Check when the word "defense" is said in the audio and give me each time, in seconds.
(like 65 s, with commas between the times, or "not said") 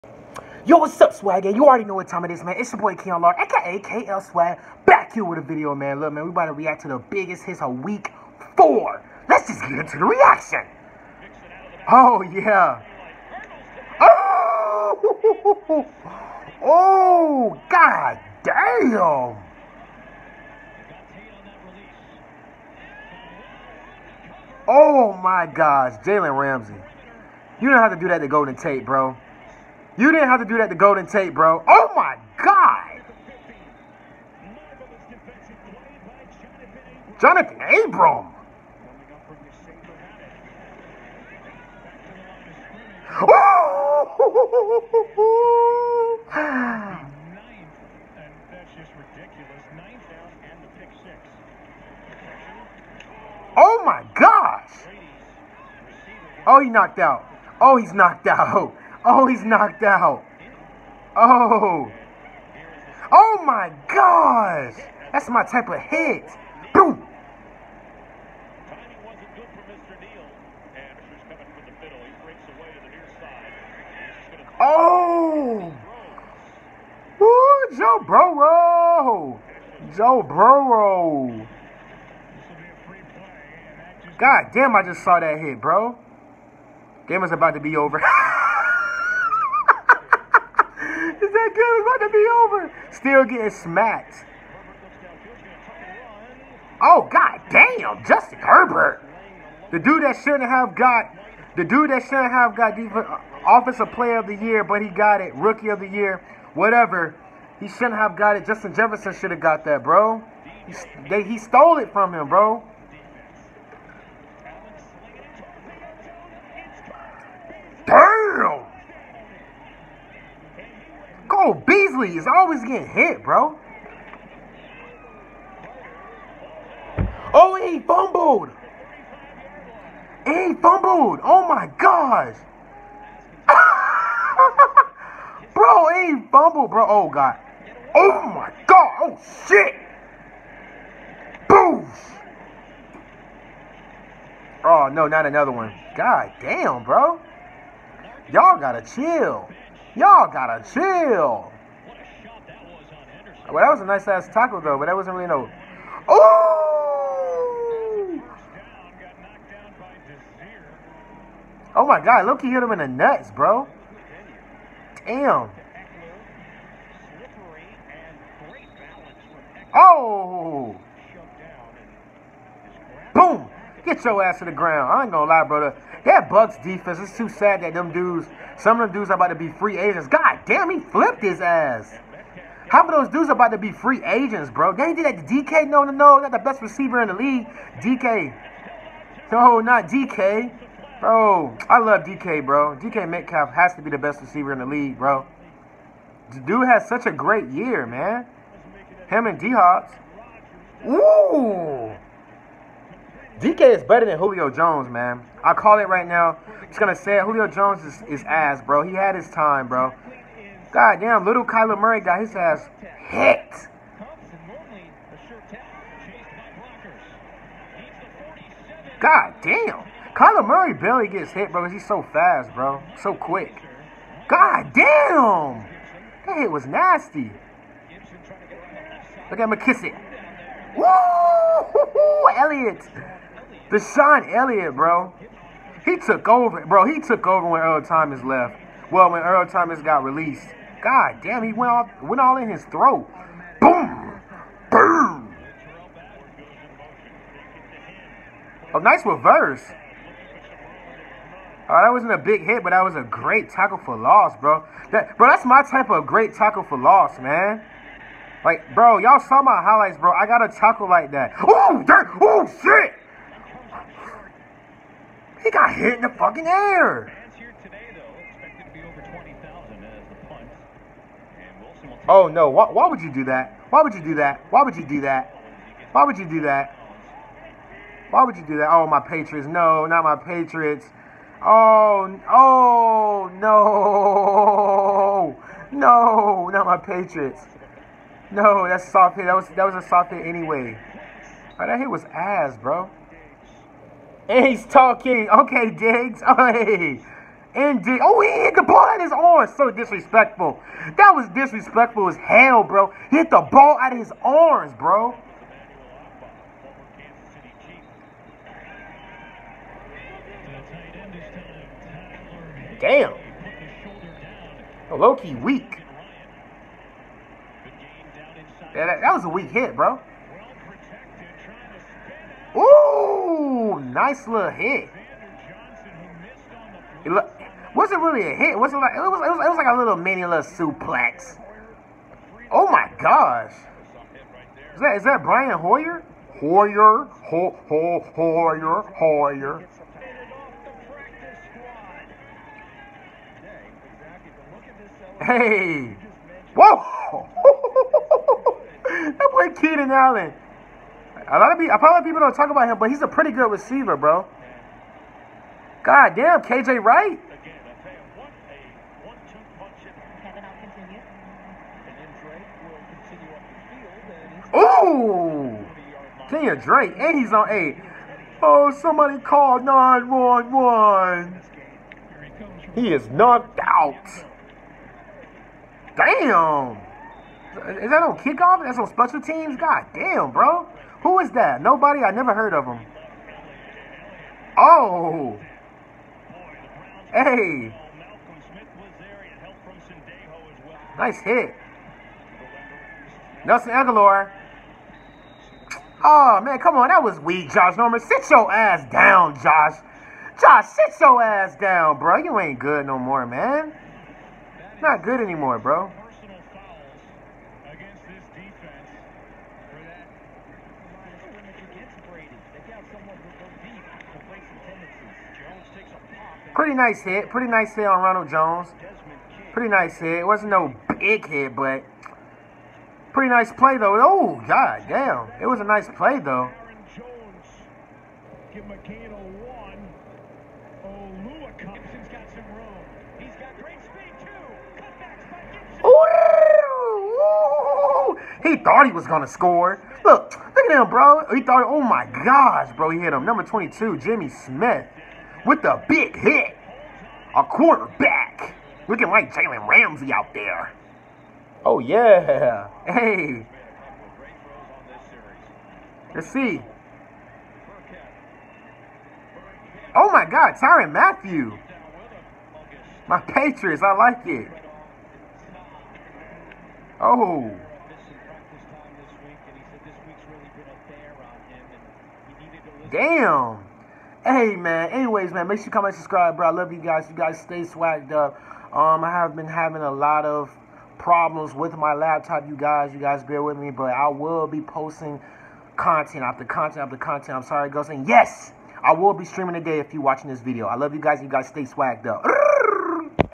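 102 s, 176 s.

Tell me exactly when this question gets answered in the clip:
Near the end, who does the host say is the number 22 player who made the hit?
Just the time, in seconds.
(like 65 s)
443 s.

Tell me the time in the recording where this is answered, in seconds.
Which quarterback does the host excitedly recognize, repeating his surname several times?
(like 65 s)
335 s.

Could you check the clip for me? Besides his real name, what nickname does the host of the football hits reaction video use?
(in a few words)
KL Swag.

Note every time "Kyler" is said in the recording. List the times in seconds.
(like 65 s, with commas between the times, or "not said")
211 s, 220 s.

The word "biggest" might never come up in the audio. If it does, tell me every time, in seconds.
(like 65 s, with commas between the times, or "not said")
7 s.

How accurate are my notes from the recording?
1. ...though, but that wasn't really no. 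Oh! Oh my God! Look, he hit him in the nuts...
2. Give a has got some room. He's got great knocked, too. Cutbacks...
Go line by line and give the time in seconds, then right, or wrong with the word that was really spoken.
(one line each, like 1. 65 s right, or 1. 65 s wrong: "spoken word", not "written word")
1. 154 s right
2. 428 s wrong: "speed", not "knocked".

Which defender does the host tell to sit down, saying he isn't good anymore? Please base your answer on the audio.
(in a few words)
Josh Norman.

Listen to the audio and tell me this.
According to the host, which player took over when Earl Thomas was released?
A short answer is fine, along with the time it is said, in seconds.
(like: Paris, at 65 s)
DeShon Elliott, at 233 s.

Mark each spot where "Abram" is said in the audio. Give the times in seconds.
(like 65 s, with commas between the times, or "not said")
37 s.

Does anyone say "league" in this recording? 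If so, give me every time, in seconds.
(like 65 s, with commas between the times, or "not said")
187 s, 194 s.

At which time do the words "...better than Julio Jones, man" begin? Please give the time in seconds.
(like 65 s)
203 s.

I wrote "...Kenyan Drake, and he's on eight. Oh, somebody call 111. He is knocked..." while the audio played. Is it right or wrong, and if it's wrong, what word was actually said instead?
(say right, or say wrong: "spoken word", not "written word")
wrong: "911", not "111".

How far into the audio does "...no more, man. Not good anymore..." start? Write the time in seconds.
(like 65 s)
402 s.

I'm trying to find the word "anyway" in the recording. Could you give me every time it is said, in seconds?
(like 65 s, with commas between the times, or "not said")
290 s, 474 s.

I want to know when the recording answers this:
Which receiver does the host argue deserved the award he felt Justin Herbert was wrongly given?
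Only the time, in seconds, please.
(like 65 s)
108 s.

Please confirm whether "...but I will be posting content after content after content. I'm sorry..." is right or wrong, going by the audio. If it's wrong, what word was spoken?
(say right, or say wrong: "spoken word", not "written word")
right.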